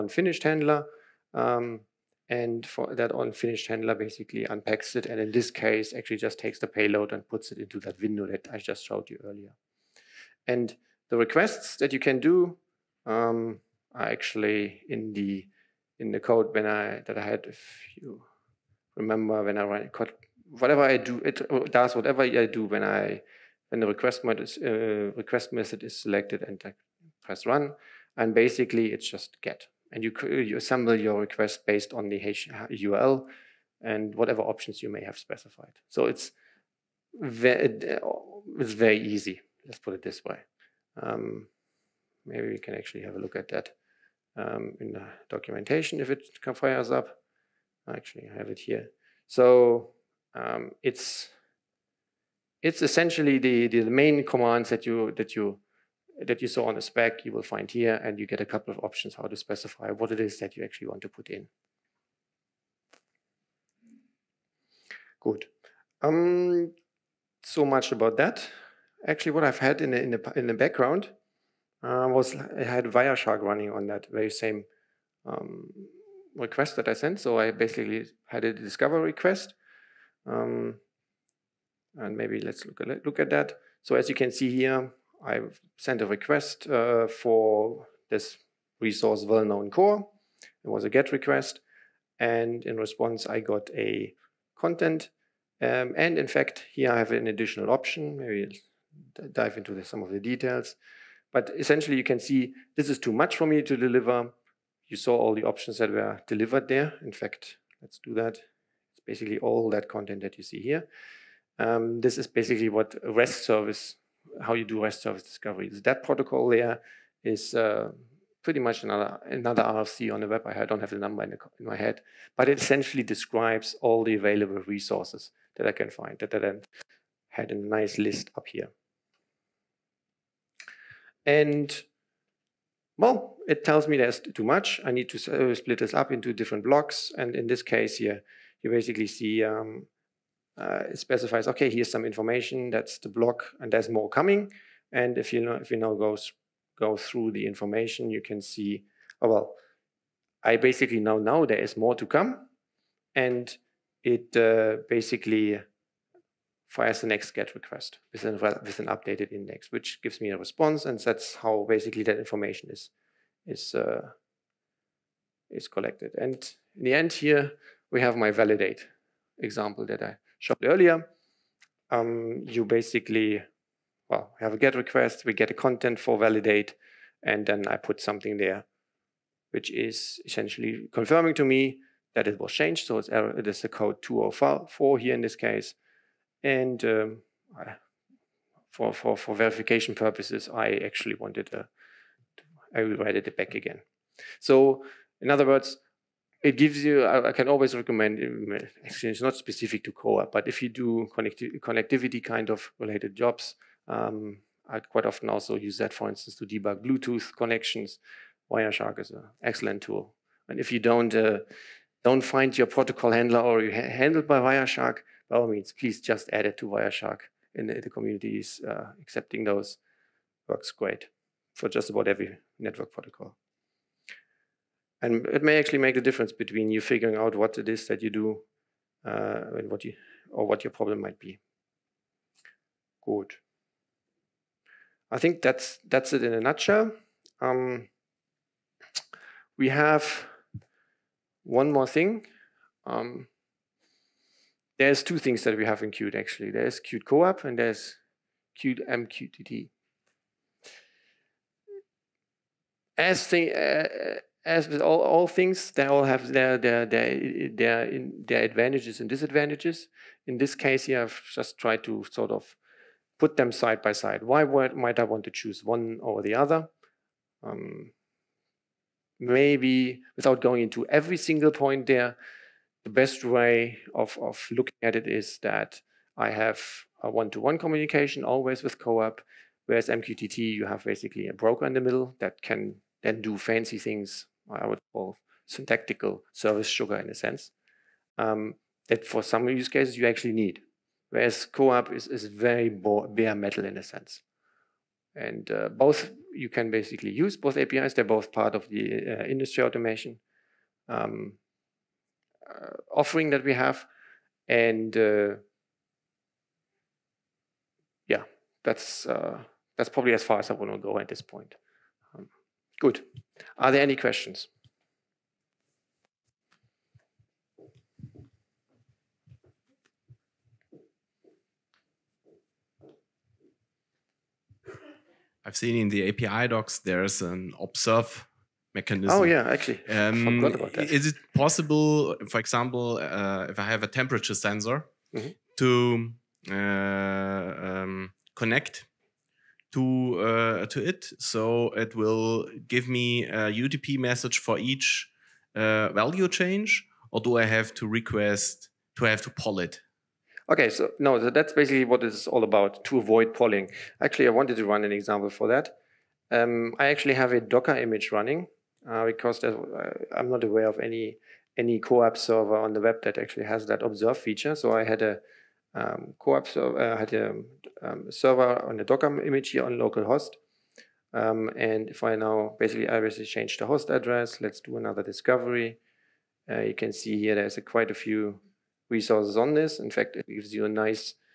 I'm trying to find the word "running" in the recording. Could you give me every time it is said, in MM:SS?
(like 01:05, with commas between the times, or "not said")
01:13, 05:58.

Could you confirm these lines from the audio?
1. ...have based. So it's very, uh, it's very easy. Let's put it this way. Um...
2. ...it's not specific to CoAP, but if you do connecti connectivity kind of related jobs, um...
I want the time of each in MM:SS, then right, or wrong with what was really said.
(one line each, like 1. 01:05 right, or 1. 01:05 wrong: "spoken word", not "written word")
1. 00:35 wrong: "specified", not "based"
2. 03:19 right.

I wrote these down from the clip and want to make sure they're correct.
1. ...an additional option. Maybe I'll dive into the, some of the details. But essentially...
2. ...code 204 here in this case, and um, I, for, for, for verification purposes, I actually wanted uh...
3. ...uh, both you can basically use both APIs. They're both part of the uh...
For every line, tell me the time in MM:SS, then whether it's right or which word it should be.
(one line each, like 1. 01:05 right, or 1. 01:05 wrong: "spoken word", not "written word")
1. 01:37 right
2. 03:03 right
3. 04:55 right.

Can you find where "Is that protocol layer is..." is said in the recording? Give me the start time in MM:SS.
01:55.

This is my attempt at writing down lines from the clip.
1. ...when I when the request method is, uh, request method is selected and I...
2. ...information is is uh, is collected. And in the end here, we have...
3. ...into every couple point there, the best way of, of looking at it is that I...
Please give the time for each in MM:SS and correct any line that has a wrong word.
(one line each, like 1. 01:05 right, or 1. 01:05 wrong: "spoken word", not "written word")
1. 00:22 right
2. 02:42 right
3. 04:30 wrong: "single", not "couple".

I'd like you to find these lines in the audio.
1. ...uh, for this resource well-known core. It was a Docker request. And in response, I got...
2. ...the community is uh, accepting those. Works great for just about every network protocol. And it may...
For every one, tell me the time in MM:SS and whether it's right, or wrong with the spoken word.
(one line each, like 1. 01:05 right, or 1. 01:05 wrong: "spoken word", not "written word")
1. 01:26 wrong: "GET", not "Docker"
2. 03:37 right.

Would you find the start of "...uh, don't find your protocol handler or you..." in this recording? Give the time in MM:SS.
03:31.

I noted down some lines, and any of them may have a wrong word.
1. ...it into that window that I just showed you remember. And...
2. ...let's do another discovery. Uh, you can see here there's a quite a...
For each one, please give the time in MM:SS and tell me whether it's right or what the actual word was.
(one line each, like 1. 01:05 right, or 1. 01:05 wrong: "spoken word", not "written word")
1. 00:07 wrong: "earlier", not "remember"
2. 06:14 right.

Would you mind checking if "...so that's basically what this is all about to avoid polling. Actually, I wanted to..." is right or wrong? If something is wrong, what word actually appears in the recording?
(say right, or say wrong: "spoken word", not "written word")
right.